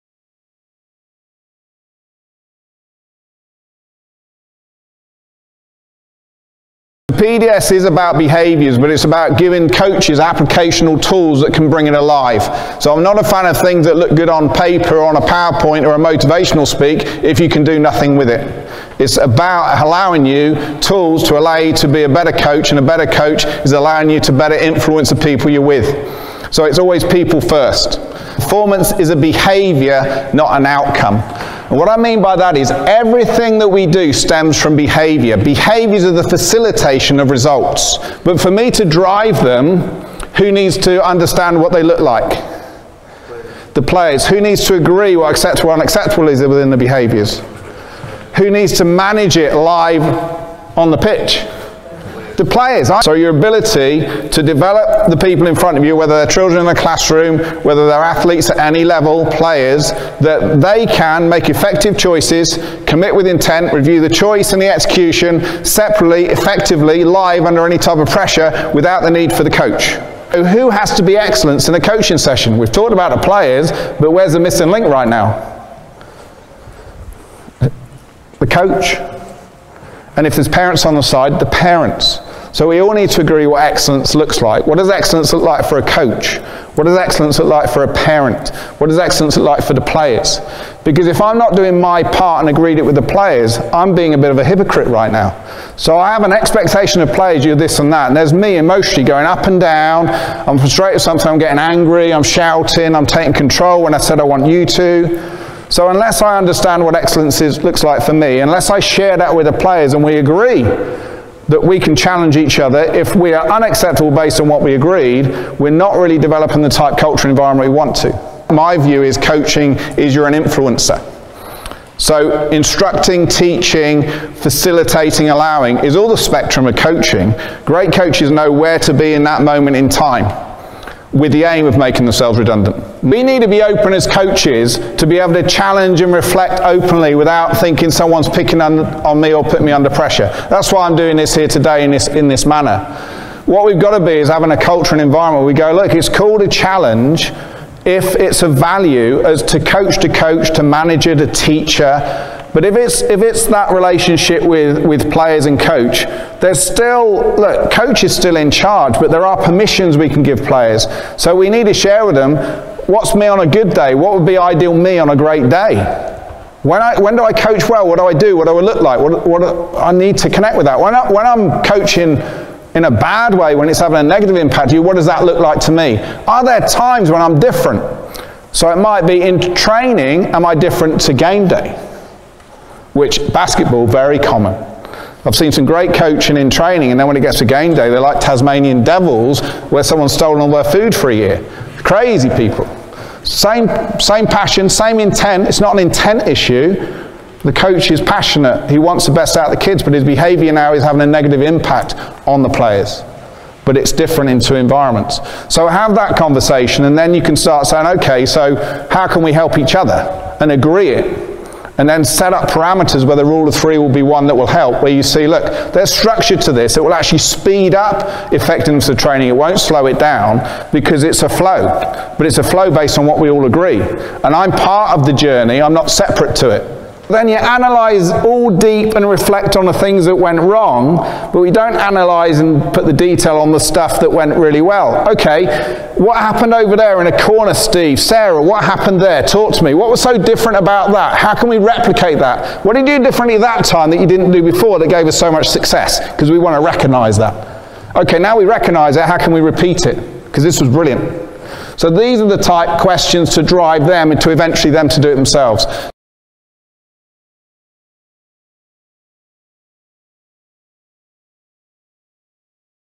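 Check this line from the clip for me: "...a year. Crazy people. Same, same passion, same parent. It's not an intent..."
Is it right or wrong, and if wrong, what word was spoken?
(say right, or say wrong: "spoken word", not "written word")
wrong: "intent", not "parent".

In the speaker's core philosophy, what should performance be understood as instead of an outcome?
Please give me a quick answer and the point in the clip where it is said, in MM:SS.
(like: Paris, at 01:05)
A behavior, at 00:29.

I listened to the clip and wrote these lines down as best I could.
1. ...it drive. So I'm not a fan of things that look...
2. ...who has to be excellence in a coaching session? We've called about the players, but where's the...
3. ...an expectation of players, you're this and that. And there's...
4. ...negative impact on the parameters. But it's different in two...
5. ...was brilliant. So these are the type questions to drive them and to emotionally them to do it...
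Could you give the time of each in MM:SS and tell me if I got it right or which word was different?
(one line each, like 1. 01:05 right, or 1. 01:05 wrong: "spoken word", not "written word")
1. 00:11 wrong: "alive", not "drive"
2. 01:10 wrong: "talked", not "called"
3. 01:36 right
4. 03:21 wrong: "players", not "parameters"
5. 04:10 wrong: "eventually", not "emotionally".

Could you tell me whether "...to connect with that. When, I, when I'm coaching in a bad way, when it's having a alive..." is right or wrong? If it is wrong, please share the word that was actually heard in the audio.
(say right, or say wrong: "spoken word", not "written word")
wrong: "negative", not "alive".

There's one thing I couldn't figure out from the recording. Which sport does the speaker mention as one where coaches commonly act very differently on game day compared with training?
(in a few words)
Basketball.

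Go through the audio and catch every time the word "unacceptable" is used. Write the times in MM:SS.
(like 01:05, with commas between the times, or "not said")
00:45, 01:53.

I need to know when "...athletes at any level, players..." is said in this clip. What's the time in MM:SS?
00:58.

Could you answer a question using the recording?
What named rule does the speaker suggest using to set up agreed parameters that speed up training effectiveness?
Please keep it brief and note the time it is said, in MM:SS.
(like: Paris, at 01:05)
Rule of three, at 03:33.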